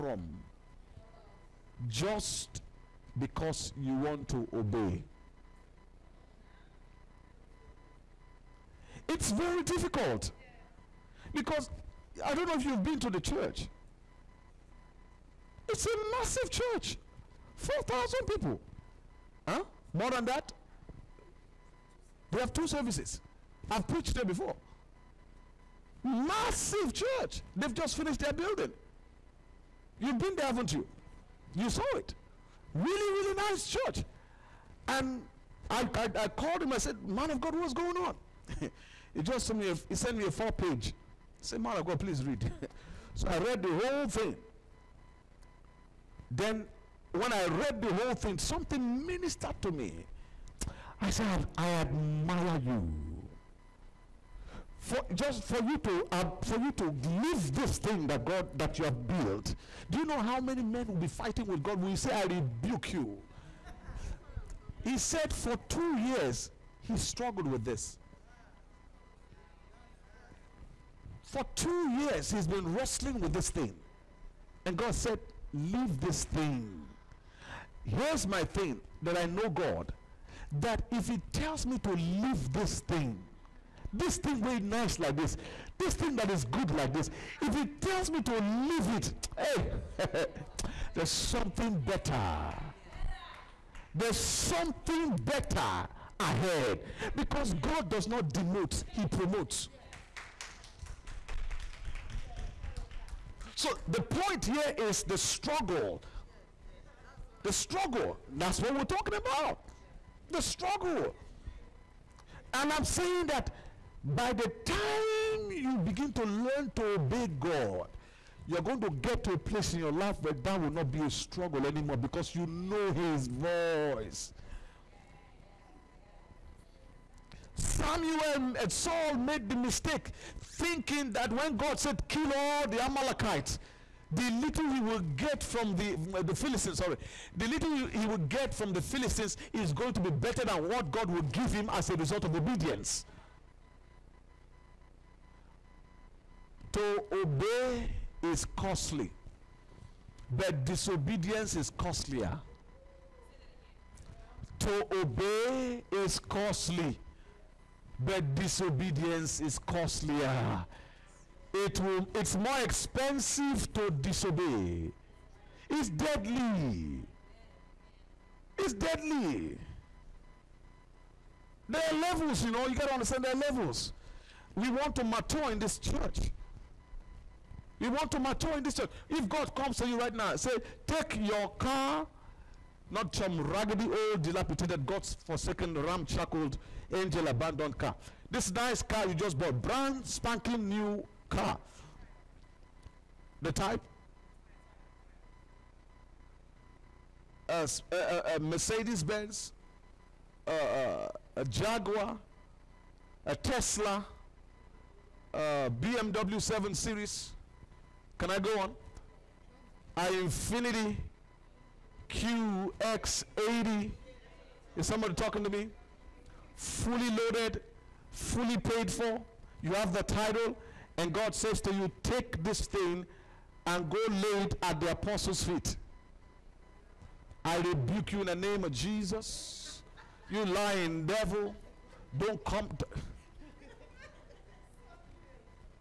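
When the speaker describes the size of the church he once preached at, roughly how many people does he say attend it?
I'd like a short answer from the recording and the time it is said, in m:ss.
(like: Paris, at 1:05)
4,000, at 0:17.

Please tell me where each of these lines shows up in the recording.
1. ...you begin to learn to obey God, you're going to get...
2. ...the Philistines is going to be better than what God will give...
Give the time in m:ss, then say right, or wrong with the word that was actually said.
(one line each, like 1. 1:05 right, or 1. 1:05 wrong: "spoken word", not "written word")
1. 1:55 right
2. 2:18 right.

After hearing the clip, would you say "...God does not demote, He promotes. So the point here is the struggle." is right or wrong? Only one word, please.
right.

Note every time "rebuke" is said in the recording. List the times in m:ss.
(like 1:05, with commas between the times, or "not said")
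1:02, 3:47.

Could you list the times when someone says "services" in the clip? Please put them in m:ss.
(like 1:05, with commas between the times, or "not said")
0:22.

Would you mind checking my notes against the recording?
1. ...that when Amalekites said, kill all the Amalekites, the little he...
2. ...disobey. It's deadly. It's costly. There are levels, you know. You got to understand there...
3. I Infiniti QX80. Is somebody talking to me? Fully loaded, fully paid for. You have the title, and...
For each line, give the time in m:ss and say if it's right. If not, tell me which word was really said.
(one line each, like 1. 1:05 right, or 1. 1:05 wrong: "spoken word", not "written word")
1. 2:11 wrong: "God", not "Amalekites"
2. 2:43 wrong: "deadly", not "costly"
3. 3:29 right.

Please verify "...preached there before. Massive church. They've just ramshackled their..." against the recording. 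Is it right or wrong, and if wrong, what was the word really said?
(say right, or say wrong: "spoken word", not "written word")
wrong: "finished", not "ramshackled".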